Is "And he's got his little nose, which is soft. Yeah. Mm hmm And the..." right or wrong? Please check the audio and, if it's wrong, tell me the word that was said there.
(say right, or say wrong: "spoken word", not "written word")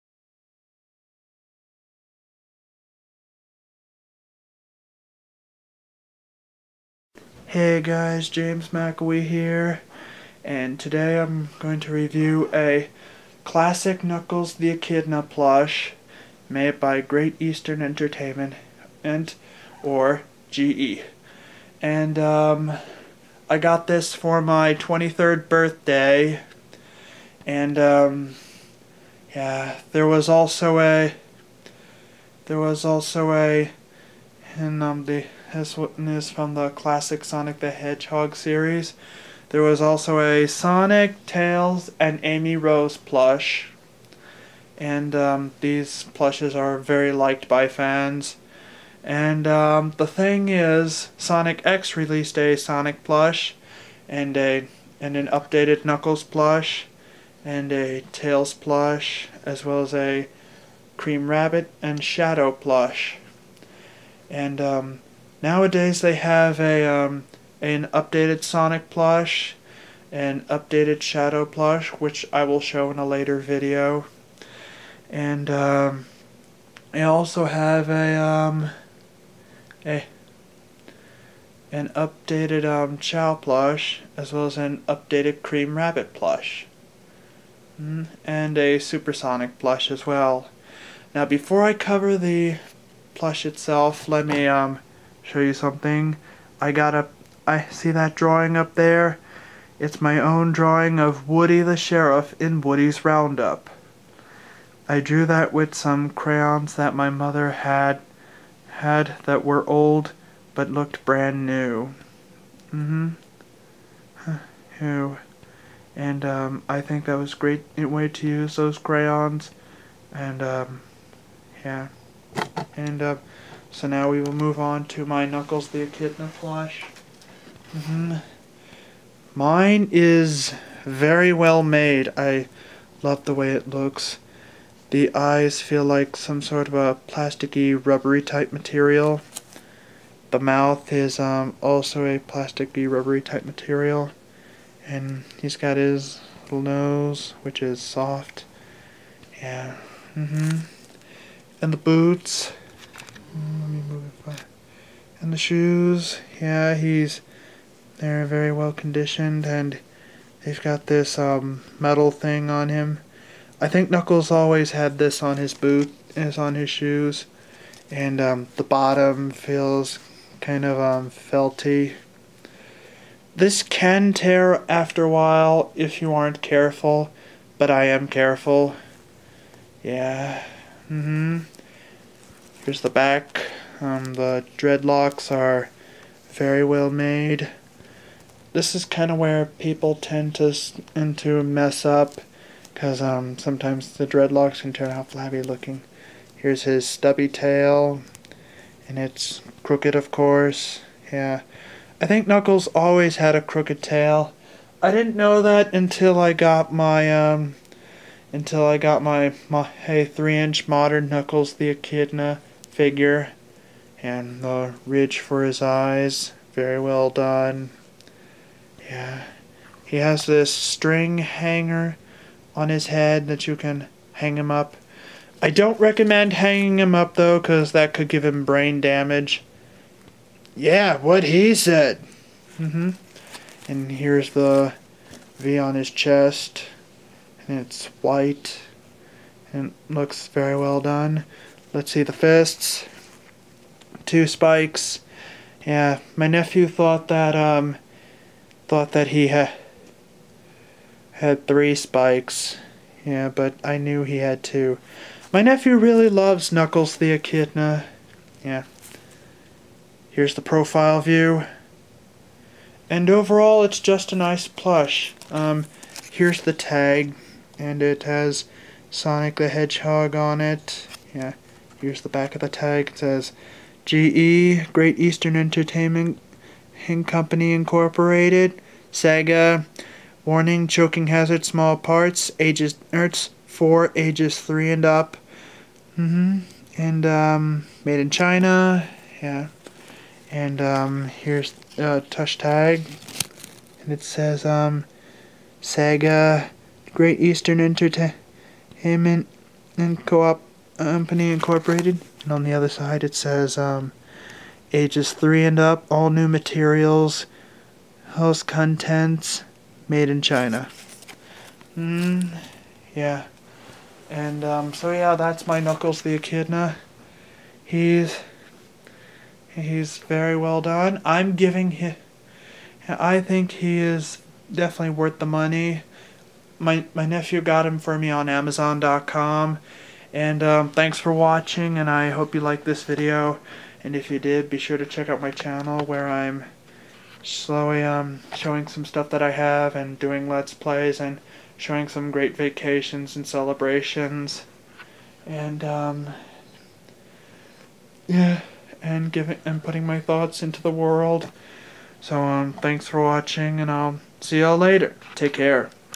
right.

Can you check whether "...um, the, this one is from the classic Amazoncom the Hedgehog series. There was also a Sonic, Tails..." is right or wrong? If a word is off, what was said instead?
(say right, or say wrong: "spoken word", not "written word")
wrong: "Sonic", not "Amazoncom".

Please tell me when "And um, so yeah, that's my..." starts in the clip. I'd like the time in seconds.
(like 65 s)
314 s.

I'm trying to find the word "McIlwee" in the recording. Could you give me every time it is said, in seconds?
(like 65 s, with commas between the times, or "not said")
8 s.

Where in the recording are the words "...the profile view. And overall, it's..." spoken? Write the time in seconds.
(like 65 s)
260 s.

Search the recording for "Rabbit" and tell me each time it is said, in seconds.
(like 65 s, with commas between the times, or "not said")
61 s, 85 s.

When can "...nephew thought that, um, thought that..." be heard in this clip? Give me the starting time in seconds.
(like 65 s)
246 s.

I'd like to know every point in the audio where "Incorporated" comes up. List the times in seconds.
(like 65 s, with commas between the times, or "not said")
277 s, 301 s.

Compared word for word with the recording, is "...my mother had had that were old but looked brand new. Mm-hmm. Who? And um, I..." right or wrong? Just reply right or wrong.
right.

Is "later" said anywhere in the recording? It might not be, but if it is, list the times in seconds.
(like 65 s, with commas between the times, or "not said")
73 s, 354 s.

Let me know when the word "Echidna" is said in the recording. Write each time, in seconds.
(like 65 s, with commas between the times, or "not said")
14 s, 125 s, 211 s, 257 s, 316 s.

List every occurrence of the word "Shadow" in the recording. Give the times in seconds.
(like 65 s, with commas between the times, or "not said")
62 s, 71 s.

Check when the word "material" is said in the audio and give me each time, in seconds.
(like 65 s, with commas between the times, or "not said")
138 s, 143 s, 306 s.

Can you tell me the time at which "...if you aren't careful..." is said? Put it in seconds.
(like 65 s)
175 s.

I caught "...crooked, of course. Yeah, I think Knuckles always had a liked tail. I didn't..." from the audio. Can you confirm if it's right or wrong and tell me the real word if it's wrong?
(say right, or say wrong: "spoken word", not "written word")
wrong: "crooked", not "liked".